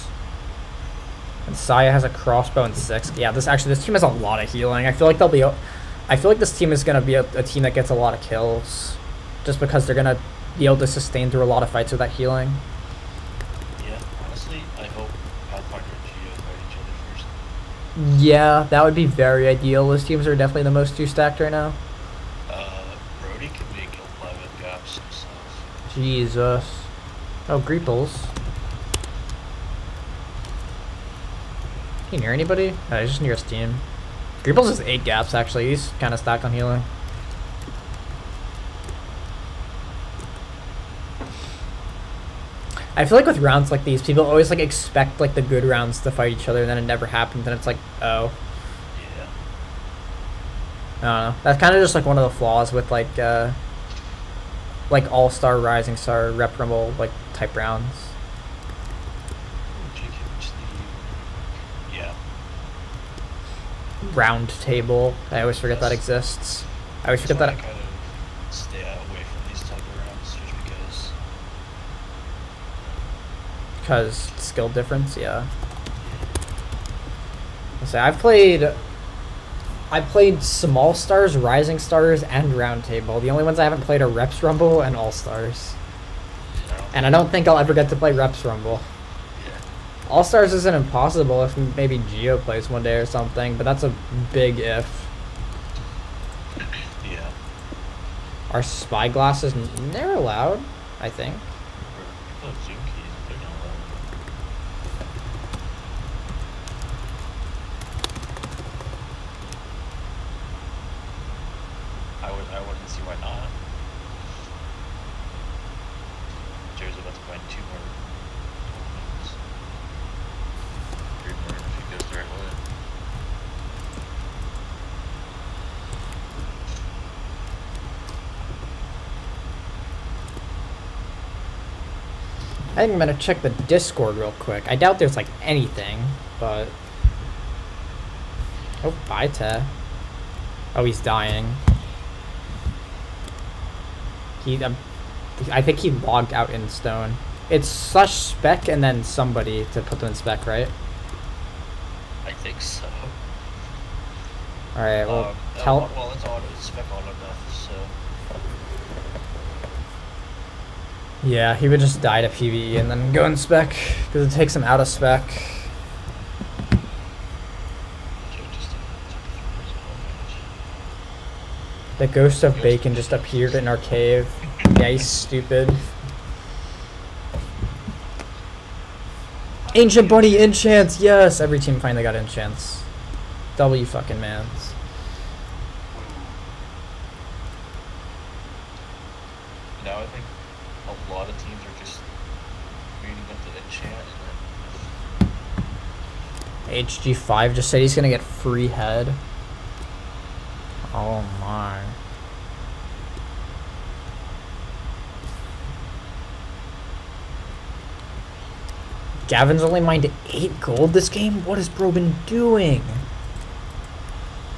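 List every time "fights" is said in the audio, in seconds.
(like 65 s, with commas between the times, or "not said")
11 s, 46 s.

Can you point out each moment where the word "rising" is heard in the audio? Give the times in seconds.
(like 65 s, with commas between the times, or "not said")
55 s, 81 s.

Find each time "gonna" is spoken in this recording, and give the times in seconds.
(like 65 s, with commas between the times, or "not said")
132 s, 197 s.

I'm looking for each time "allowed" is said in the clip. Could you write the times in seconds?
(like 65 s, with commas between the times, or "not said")
100 s.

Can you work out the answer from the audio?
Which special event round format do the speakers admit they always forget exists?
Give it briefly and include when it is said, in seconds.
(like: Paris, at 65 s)
Round table, at 64 s.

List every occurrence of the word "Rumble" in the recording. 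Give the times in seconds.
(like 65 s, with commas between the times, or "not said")
56 s, 84 s, 88 s.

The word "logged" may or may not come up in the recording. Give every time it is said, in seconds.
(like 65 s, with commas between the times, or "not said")
145 s.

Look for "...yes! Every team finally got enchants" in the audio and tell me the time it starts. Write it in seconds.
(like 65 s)
180 s.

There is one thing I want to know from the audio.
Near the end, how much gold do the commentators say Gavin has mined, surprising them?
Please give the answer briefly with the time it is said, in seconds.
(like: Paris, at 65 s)
8, at 210 s.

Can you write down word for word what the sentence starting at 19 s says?
Those teams are definitely the most two stacked right now.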